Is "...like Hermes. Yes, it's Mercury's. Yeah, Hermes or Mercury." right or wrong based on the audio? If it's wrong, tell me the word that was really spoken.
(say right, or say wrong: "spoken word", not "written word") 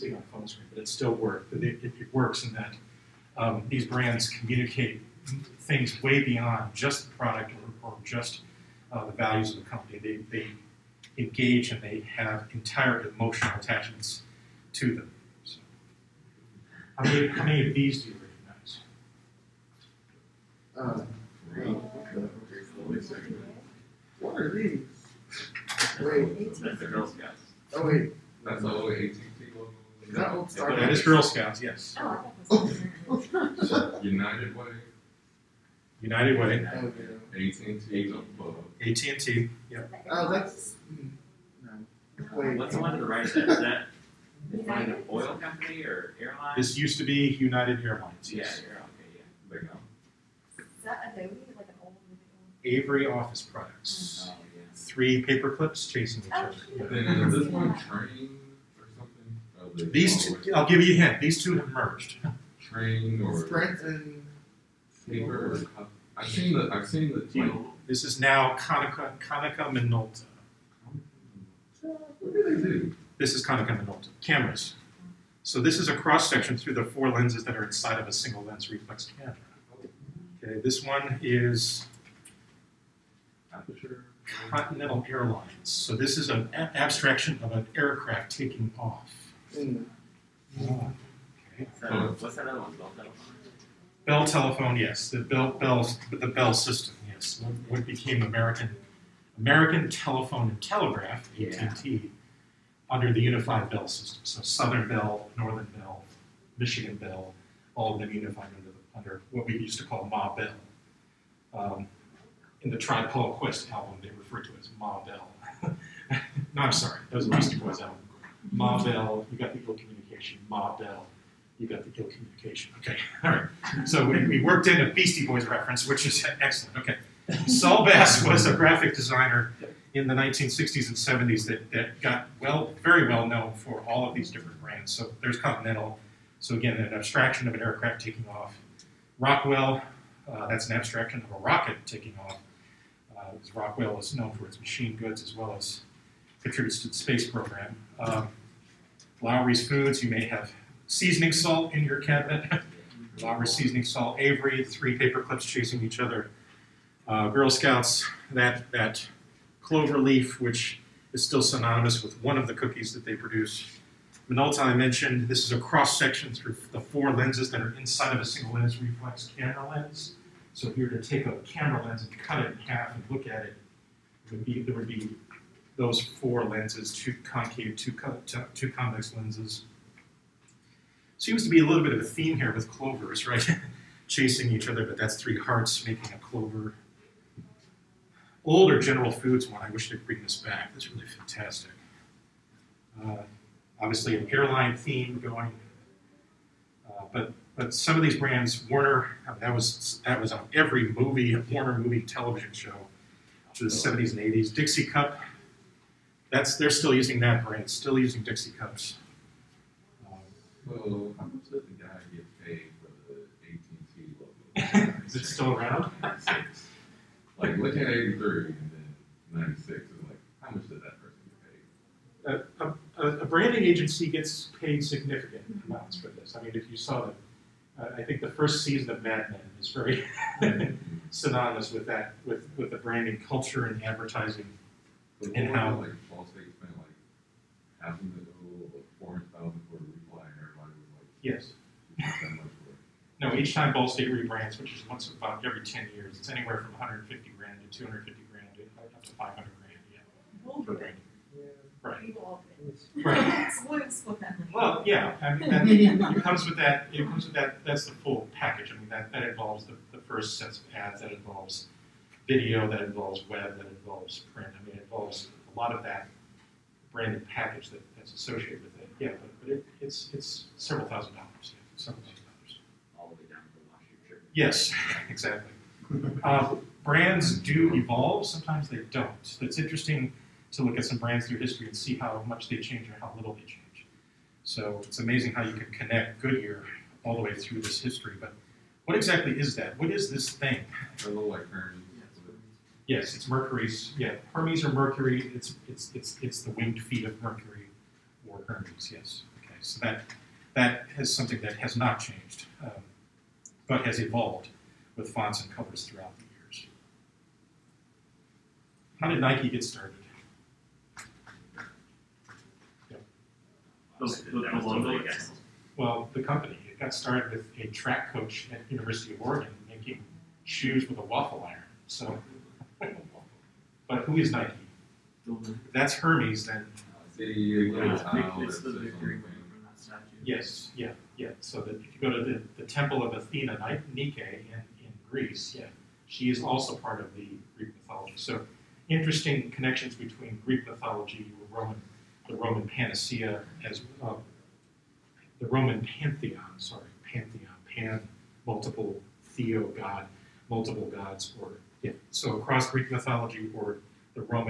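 right.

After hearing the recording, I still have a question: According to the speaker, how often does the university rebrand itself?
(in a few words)
every 10 years.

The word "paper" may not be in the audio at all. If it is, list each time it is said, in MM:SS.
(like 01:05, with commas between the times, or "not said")
00:55, 01:05, 02:34.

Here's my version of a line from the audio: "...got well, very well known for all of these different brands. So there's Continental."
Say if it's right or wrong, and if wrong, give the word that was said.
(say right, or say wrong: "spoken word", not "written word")
right.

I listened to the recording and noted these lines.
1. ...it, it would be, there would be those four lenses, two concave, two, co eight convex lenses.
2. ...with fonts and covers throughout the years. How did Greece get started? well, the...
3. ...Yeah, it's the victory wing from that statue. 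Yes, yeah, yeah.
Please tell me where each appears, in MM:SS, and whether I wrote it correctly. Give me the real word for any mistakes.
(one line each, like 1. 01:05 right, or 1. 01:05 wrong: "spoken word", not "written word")
1. 02:53 wrong: "two", not "eight"
2. 05:04 wrong: "Nike", not "Greece"
3. 05:27 right.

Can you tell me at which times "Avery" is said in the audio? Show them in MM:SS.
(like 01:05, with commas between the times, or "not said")
00:52, 02:34.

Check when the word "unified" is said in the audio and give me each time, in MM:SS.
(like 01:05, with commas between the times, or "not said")
01:43, 01:48.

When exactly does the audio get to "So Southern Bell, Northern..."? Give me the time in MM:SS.
01:44.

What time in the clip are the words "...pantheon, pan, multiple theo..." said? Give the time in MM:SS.
05:47.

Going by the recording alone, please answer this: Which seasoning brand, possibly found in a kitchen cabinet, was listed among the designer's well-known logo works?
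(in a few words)
Lawry's.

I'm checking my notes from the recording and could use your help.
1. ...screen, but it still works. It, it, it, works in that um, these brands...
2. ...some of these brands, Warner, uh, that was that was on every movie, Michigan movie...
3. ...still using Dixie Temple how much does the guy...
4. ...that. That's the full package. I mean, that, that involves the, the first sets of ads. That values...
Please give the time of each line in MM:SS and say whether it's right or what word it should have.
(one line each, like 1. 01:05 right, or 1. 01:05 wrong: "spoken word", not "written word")
1. 00:00 right
2. 03:17 wrong: "Warner", not "Michigan"
3. 03:27 wrong: "Cups", not "Temple"
4. 04:17 wrong: "involves", not "values".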